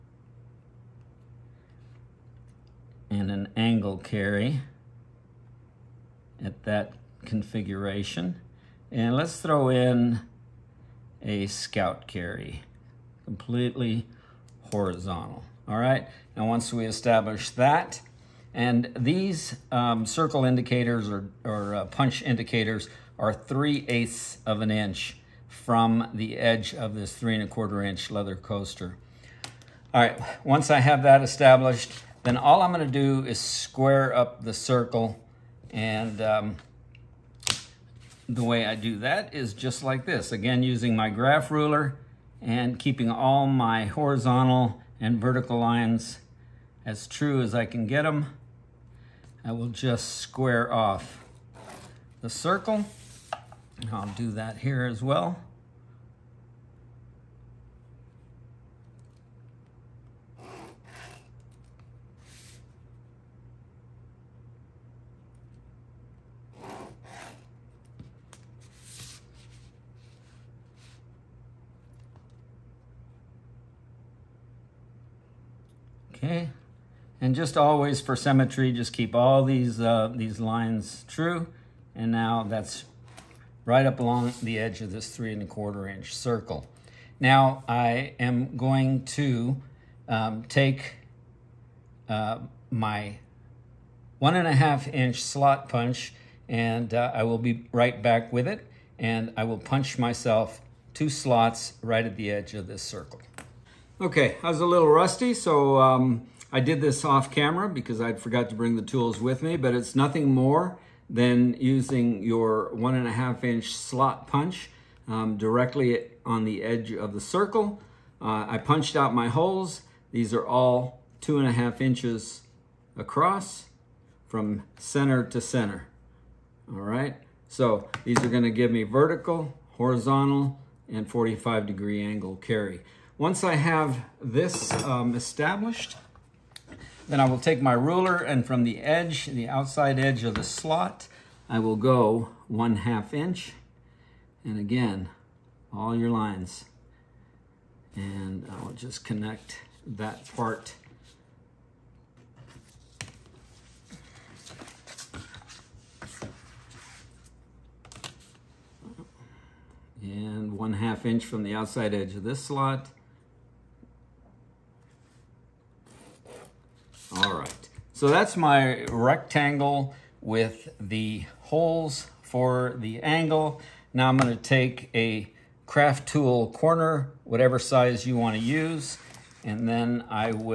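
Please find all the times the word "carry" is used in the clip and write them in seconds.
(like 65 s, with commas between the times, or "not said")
3 s, 12 s, 132 s.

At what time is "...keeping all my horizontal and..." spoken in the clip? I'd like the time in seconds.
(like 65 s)
42 s.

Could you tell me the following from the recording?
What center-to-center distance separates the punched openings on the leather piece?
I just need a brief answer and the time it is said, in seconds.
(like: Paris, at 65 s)
2 1/2 inches, at 121 s.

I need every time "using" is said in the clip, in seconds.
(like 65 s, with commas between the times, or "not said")
40 s, 111 s.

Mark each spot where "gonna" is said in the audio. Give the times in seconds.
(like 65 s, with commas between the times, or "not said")
32 s, 128 s, 174 s.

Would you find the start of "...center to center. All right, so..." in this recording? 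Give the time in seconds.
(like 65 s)
124 s.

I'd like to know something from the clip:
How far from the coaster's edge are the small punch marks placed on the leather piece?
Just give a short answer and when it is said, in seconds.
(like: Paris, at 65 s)
3/8 inch, at 23 s.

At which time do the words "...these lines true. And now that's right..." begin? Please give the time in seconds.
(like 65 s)
80 s.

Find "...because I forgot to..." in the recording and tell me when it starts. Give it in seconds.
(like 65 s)
107 s.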